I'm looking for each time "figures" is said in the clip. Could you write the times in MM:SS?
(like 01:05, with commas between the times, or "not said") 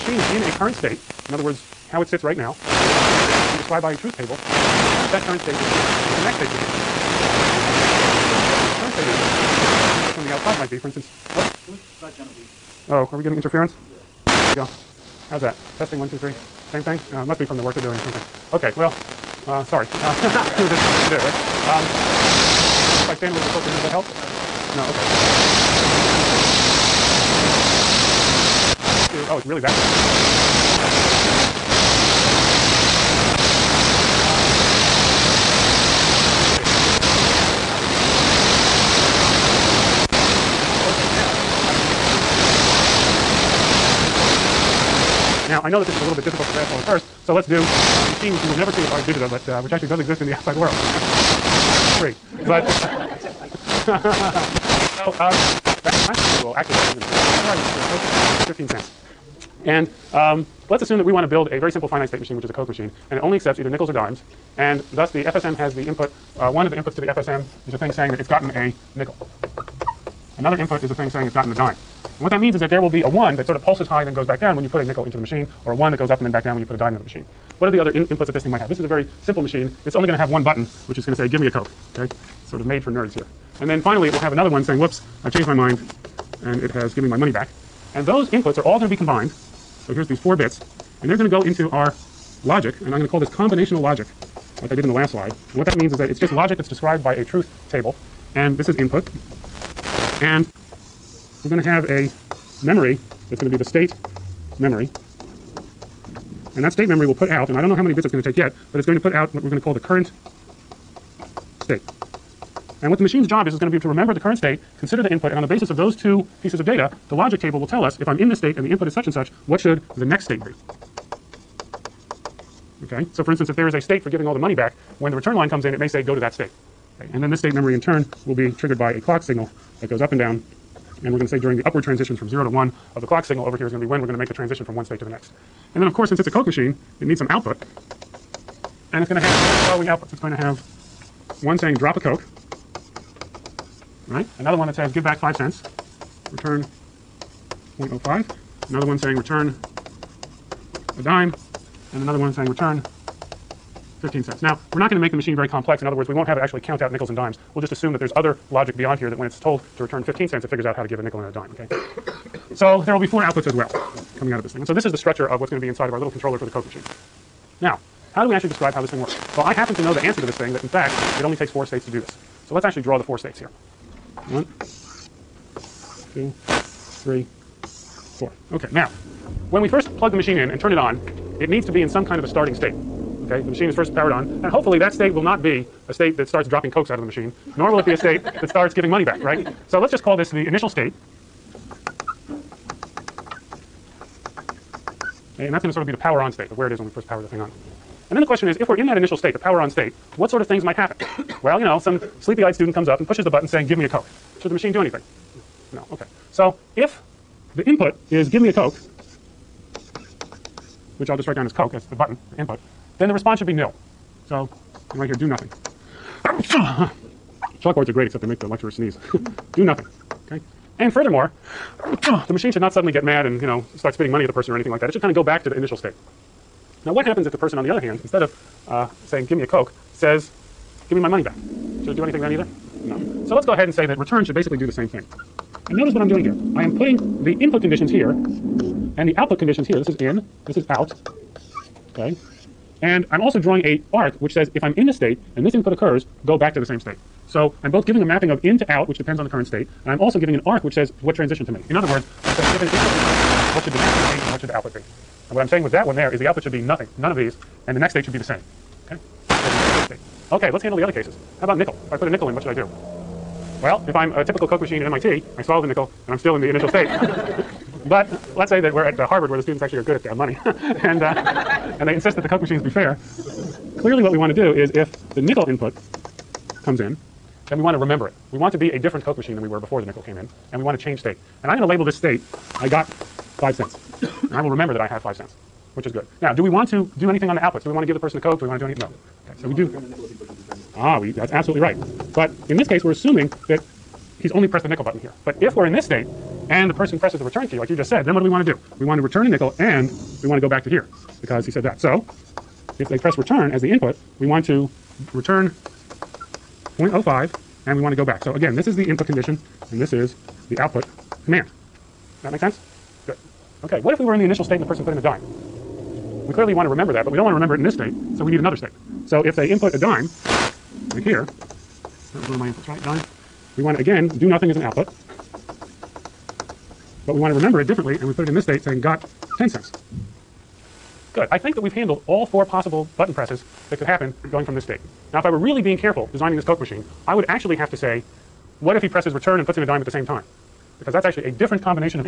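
02:40.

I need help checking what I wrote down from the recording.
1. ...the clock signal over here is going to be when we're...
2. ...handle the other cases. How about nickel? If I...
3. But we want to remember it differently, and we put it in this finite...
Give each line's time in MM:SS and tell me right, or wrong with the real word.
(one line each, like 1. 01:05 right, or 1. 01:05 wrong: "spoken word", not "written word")
1. 02:13 right
2. 04:20 right
3. 05:27 wrong: "state", not "finite".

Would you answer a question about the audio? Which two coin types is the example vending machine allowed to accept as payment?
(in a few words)
nickels or dimes.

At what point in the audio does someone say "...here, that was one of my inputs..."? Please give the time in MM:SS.
05:21.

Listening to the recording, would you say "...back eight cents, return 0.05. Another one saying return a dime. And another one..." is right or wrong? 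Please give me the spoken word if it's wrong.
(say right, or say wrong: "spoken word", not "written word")
wrong: "five", not "eight".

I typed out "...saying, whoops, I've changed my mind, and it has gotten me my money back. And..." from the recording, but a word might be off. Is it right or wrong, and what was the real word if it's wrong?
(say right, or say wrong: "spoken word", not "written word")
wrong: "given", not "gotten".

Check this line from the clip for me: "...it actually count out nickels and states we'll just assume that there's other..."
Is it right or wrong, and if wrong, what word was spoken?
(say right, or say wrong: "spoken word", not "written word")
wrong: "dimes", not "states".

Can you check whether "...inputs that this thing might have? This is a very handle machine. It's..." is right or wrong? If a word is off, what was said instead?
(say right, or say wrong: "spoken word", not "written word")
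wrong: "simple", not "handle".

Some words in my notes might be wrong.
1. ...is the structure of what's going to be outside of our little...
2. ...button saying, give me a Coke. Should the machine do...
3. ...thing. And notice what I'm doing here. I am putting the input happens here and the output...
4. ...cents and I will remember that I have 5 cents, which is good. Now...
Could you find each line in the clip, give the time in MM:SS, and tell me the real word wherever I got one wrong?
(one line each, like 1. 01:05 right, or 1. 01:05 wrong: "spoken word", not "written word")
1. 02:44 wrong: "inside", not "outside"
2. 03:23 right
3. 03:54 wrong: "conditions", not "happens"
4. 04:43 right.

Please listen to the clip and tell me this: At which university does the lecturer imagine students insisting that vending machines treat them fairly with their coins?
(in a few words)
Harvard.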